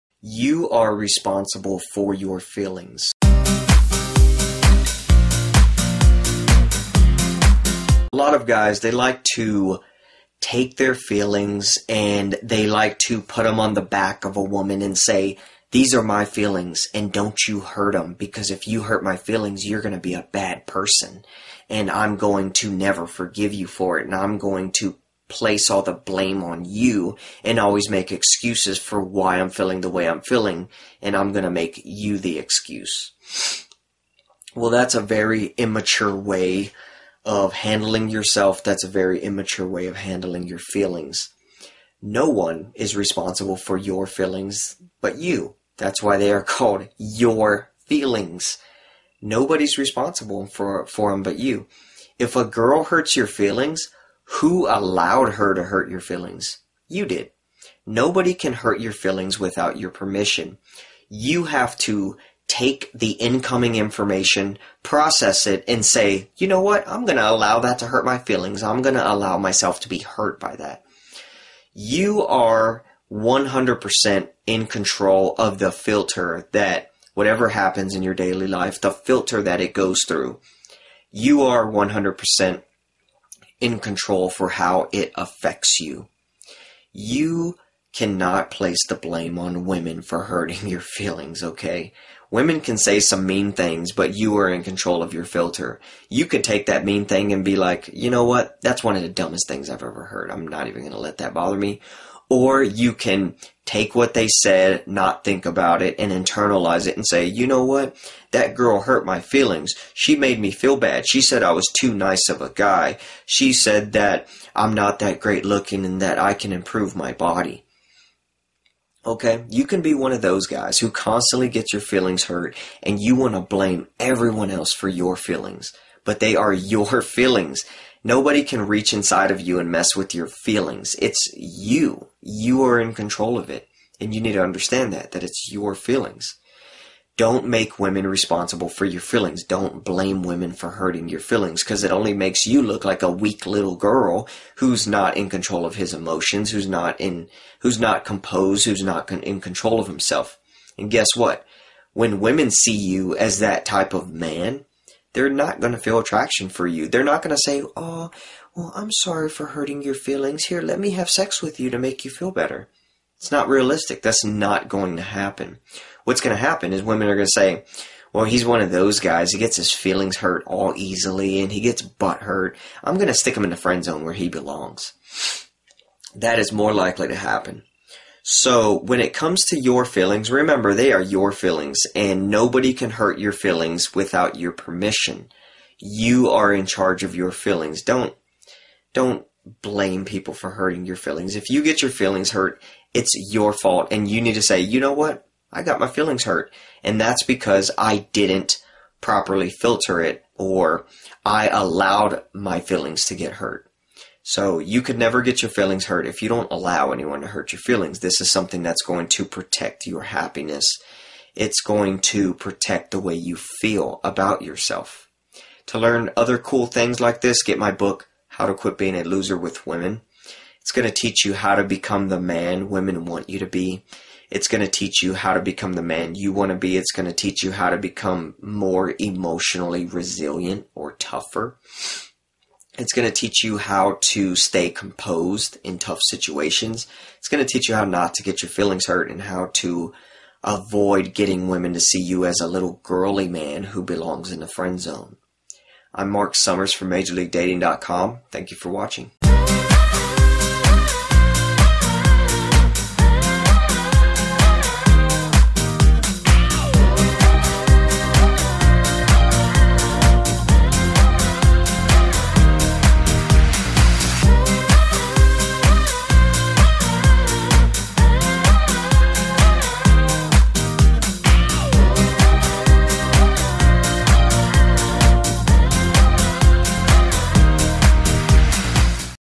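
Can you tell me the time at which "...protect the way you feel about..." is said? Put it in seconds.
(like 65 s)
212 s.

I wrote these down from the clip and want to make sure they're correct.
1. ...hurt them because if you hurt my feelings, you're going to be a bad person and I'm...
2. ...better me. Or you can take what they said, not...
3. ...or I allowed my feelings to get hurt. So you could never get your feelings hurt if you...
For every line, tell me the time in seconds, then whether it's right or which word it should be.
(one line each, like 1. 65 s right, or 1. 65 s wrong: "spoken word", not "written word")
1. 17 s right
2. 101 s wrong: "bother", not "better"
3. 200 s right.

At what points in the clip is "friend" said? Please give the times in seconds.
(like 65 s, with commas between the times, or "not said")
173 s, 244 s.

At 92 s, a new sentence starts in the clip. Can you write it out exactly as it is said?
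Women can say some mean things, but you are in control of your filter.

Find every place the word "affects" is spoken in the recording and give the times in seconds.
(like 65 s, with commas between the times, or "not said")
85 s.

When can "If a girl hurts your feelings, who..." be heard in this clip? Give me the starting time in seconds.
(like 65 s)
52 s.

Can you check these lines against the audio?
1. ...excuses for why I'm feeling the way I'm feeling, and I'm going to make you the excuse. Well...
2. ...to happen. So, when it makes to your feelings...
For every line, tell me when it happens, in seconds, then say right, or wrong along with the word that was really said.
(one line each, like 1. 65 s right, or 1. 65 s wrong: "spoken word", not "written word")
1. 28 s right
2. 177 s wrong: "comes", not "makes".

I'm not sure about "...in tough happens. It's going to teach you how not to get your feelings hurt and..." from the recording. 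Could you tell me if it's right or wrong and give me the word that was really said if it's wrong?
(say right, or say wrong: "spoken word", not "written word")
wrong: "situations", not "happens".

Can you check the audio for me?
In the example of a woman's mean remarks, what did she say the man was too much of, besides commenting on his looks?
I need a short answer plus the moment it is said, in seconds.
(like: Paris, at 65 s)
too nice of a guy, at 111 s.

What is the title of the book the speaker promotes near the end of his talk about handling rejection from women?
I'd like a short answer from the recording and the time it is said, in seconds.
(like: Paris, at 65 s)
How to Quit Being a Loser with Women, at 218 s.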